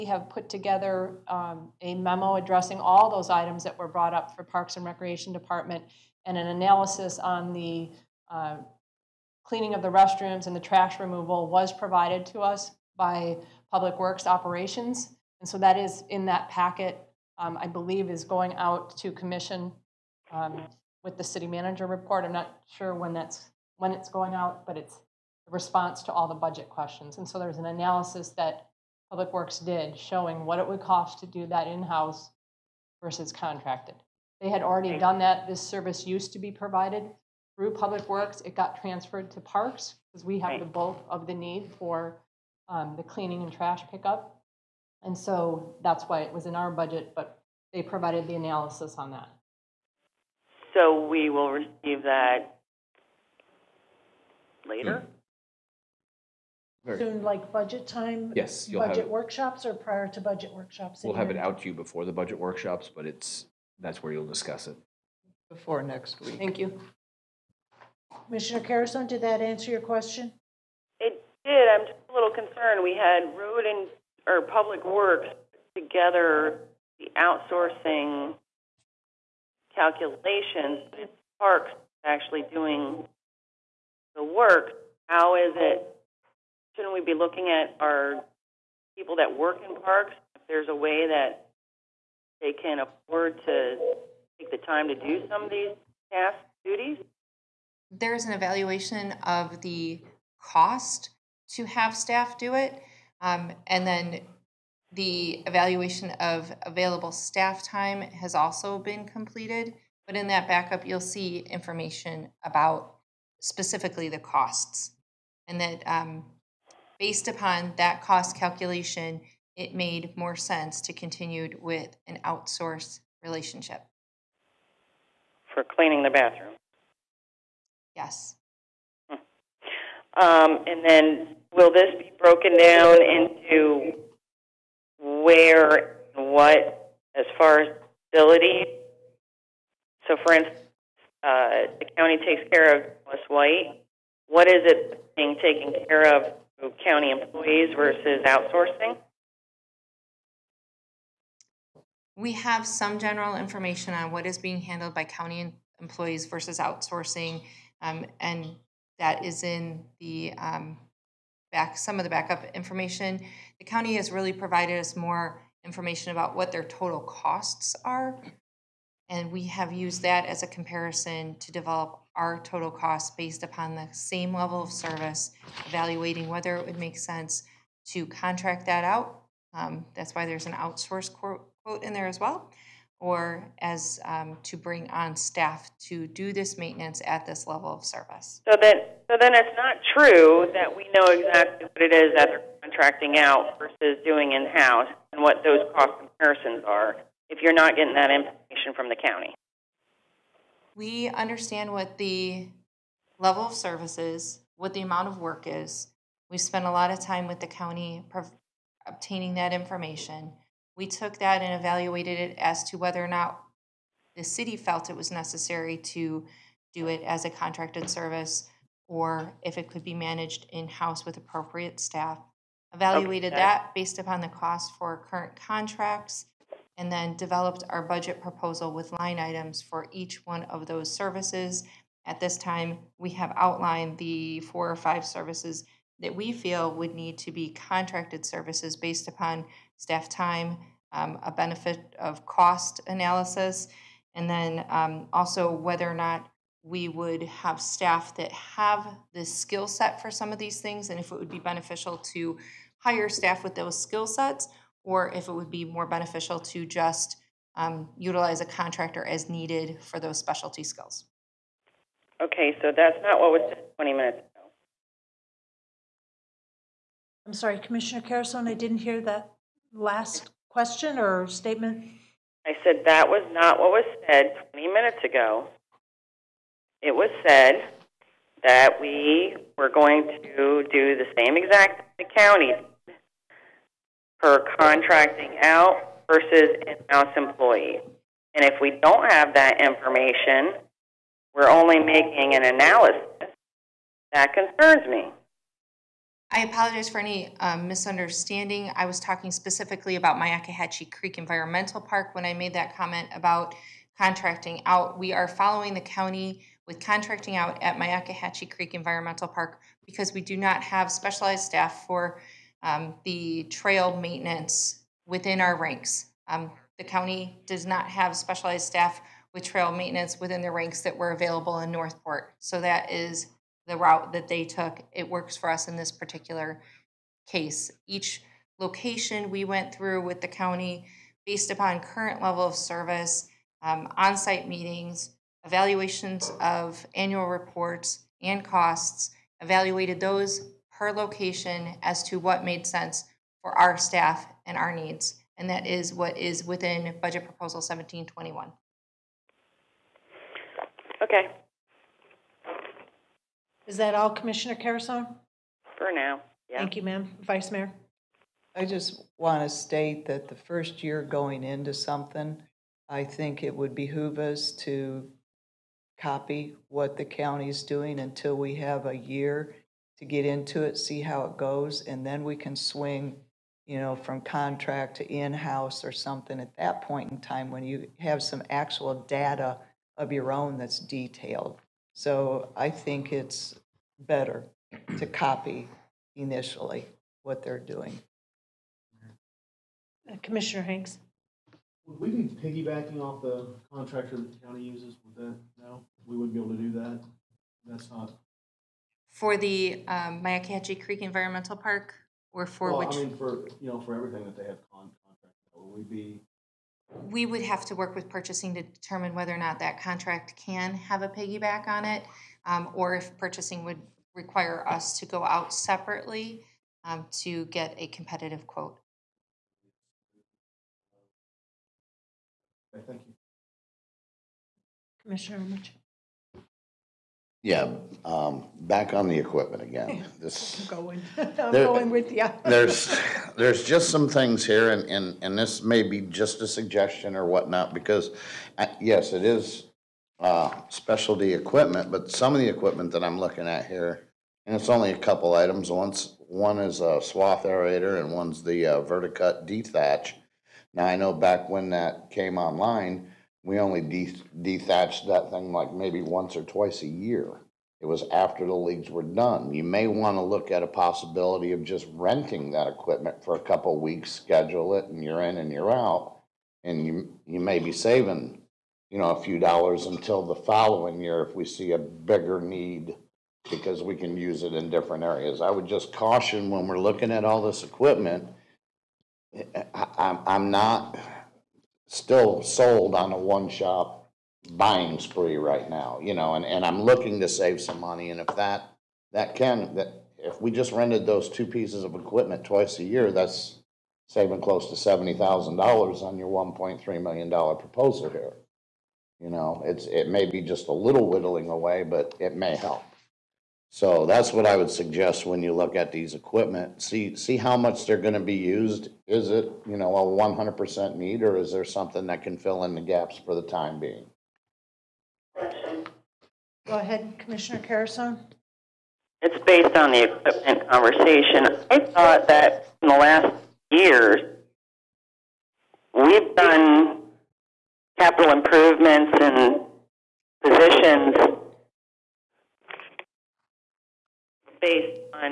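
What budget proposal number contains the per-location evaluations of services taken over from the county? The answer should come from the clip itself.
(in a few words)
1721.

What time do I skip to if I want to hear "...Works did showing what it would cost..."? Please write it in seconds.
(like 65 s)
29 s.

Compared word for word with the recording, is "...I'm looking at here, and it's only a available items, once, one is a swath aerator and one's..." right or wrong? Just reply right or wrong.
wrong.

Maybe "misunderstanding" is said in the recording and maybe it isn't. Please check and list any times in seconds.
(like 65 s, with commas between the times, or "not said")
297 s.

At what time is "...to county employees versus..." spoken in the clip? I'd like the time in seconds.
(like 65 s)
146 s.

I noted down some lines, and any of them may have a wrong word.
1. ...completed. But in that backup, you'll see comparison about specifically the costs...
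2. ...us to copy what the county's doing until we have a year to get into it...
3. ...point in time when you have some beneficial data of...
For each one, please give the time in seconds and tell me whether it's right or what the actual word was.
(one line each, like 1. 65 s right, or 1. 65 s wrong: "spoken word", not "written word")
1. 109 s wrong: "information", not "comparison"
2. 364 s right
3. 376 s wrong: "actual", not "beneficial".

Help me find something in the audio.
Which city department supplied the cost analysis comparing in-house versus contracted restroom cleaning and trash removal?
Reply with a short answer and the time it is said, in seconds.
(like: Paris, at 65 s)
Public Works Operations, at 13 s.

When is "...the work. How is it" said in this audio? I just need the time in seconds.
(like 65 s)
84 s.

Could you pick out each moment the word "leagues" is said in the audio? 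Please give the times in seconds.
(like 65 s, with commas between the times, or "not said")
458 s.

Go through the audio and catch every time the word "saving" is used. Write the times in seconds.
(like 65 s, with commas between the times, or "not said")
467 s, 494 s.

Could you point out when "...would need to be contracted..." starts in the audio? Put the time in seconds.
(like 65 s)
236 s.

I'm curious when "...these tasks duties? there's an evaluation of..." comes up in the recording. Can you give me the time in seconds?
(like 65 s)
95 s.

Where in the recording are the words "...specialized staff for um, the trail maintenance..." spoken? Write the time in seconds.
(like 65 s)
310 s.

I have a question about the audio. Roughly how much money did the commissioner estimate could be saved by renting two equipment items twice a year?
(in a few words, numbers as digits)
$70,000.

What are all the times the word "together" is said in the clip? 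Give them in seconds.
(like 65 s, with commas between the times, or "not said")
0 s, 75 s.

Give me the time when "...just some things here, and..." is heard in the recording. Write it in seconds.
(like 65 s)
433 s.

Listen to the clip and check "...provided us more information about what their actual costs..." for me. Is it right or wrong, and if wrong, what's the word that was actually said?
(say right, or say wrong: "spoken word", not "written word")
wrong: "total", not "actual".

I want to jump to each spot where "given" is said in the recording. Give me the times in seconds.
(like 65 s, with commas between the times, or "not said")
not said.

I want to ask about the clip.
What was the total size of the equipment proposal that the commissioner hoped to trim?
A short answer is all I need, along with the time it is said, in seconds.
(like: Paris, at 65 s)
$1.3 million, at 496 s.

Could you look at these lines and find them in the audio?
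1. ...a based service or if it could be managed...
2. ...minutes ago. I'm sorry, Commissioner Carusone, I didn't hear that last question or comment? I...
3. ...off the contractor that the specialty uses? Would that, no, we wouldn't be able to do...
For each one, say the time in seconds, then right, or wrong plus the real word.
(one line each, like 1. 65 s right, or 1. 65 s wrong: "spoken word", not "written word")
1. 217 s wrong: "contracted", not "based"
2. 263 s wrong: "statement", not "comment"
3. 393 s wrong: "county", not "specialty".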